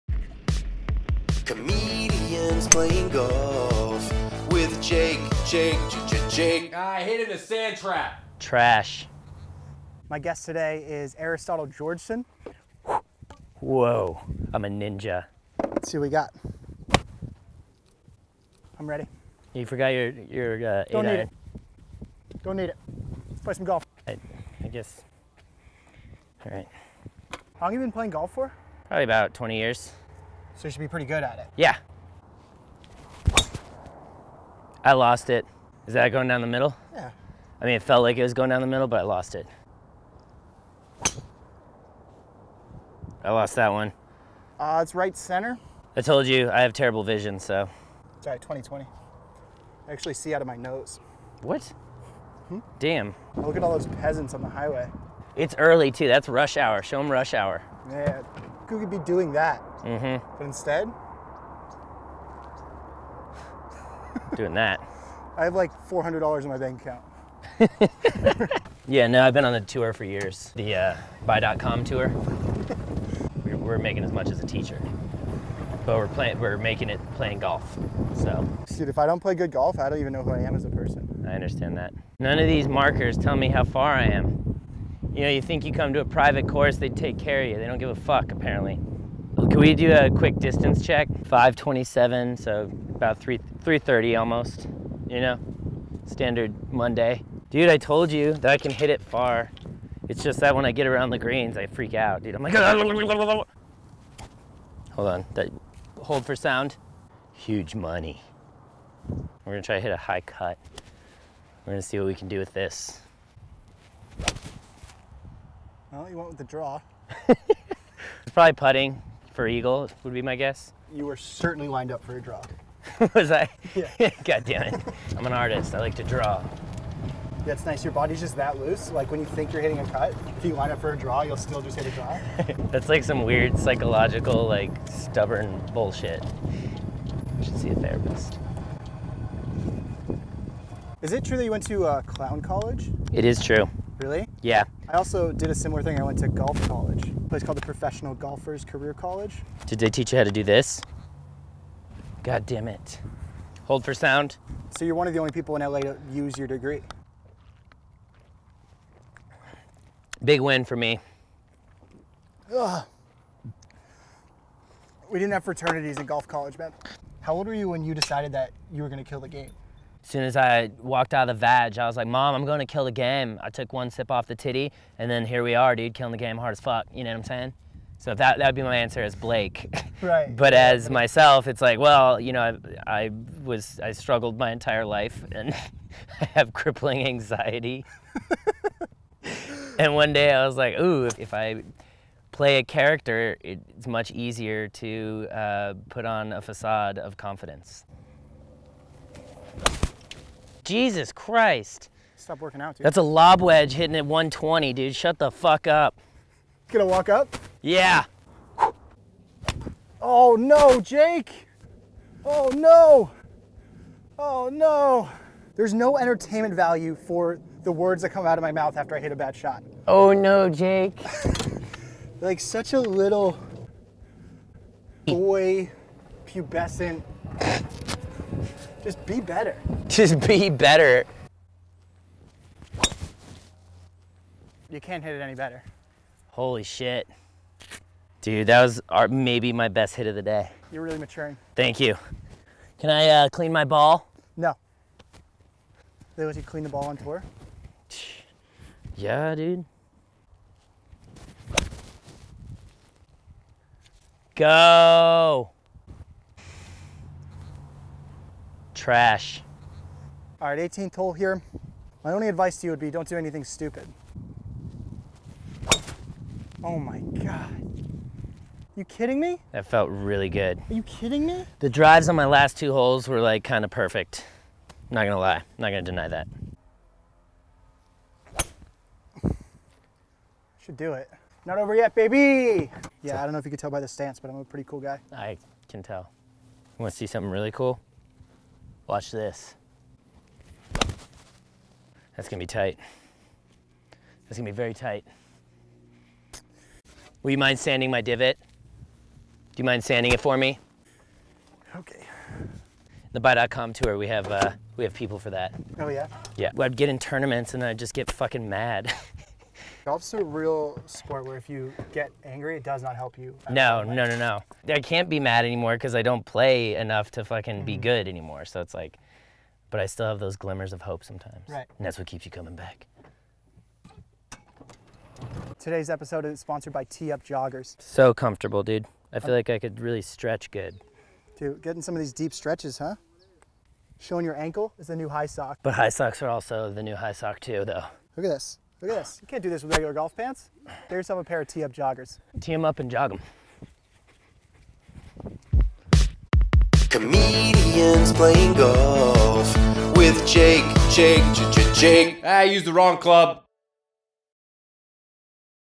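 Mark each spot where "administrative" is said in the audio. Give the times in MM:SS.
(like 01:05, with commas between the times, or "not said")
not said.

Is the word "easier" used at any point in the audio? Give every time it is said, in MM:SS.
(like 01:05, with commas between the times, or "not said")
03:14.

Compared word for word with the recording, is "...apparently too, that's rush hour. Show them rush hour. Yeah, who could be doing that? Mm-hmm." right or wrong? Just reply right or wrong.
wrong.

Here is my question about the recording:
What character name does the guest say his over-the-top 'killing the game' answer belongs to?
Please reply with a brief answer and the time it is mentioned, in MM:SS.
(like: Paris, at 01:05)
Blake, at 02:59.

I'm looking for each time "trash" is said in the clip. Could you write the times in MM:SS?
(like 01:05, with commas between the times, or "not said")
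00:08, 04:18.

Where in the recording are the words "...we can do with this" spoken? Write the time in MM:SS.
01:52.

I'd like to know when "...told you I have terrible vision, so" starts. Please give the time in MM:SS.
00:46.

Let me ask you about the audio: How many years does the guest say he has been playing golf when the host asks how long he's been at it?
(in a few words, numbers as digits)
20 years.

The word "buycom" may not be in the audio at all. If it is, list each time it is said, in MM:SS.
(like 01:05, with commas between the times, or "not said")
01:11, 05:03.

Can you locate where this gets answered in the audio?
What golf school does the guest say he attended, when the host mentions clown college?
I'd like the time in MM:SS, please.
02:27.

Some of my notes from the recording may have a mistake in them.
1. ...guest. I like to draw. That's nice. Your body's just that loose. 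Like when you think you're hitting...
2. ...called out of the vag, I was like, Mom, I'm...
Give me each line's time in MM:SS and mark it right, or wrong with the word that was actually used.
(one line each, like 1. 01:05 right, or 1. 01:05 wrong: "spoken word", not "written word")
1. 02:05 wrong: "artist", not "guest"
2. 02:50 wrong: "walked", not "called".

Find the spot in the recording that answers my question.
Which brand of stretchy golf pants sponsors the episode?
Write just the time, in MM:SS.
05:26.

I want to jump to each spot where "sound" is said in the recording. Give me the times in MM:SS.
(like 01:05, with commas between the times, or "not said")
01:46, 02:33.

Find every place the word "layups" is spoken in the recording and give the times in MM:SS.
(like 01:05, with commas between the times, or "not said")
not said.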